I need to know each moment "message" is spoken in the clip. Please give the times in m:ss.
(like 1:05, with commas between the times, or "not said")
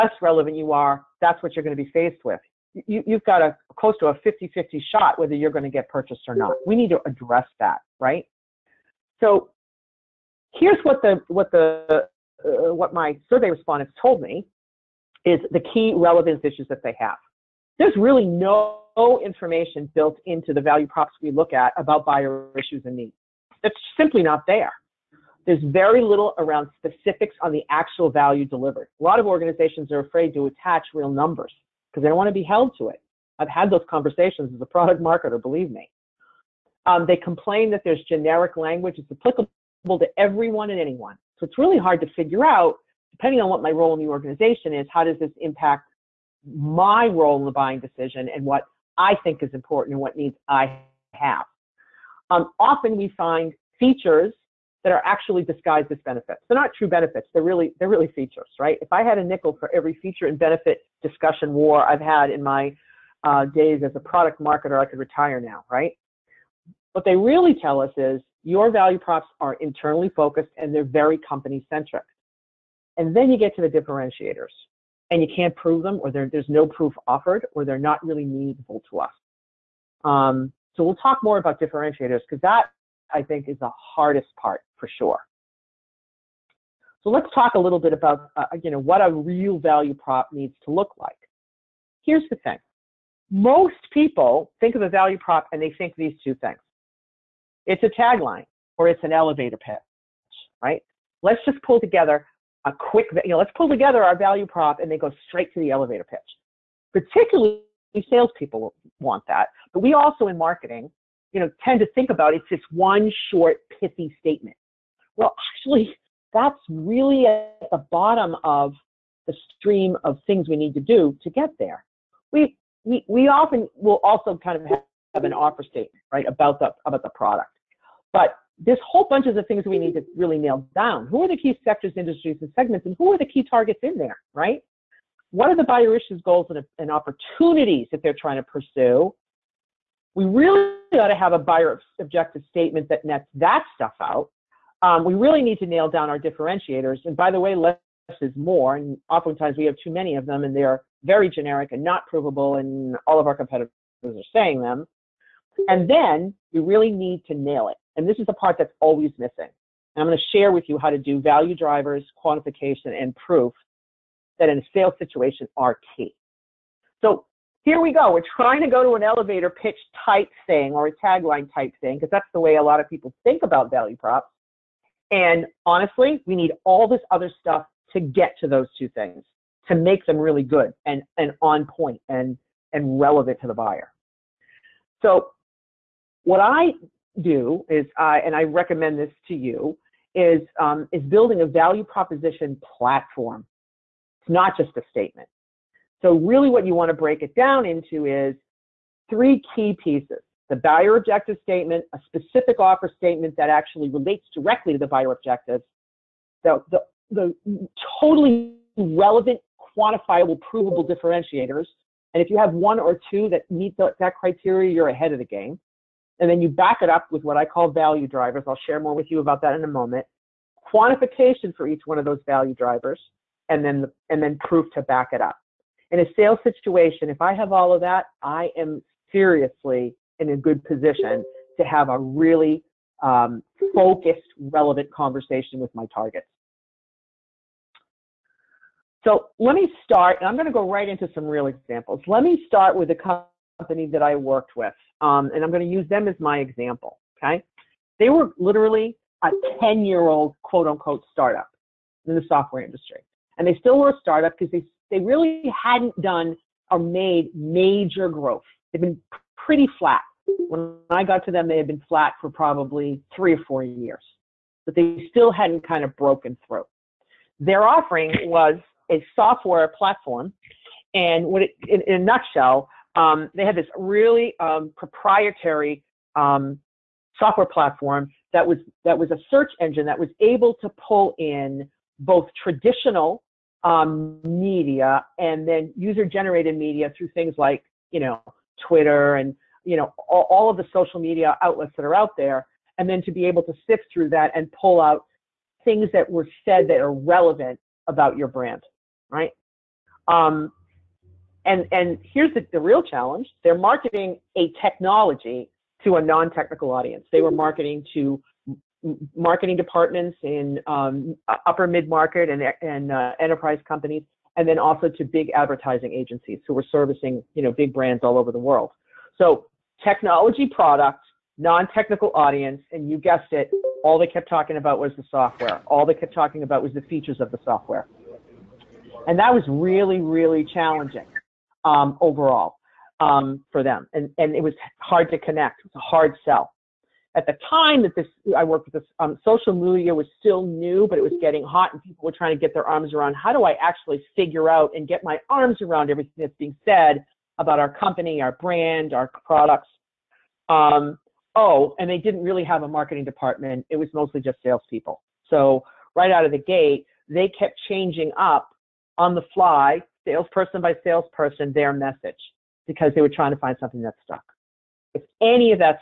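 6:01.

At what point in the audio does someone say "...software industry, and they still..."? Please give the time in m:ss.
4:12.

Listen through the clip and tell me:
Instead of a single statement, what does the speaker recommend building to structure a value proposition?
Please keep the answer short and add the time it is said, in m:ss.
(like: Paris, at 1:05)
Value proposition platform, at 3:11.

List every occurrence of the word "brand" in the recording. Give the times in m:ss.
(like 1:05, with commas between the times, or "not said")
4:58, 5:17, 5:48.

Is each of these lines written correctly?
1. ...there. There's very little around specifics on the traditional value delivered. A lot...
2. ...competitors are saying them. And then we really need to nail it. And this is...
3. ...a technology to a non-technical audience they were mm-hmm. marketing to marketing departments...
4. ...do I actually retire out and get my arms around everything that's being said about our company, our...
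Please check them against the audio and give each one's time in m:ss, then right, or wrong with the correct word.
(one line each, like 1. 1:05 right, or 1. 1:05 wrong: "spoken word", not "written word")
1. 0:24 wrong: "actual", not "traditional"
2. 2:33 right
3. 5:04 right
4. 5:43 wrong: "figure", not "retire".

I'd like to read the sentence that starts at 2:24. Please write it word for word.
Um, we really need to nail down our differentiators.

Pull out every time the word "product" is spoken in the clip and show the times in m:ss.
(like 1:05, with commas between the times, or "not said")
0:34, 1:03, 2:07, 5:20, 5:49.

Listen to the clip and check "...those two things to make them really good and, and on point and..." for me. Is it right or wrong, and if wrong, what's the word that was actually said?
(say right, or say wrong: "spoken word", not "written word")
right.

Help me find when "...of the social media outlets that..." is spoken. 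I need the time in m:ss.
4:50.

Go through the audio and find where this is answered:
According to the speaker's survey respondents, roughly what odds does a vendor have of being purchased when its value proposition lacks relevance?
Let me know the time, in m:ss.
0:04.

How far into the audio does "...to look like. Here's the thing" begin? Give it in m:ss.
1:30.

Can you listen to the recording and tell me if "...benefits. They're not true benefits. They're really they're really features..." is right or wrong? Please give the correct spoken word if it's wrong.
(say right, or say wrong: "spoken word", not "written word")
right.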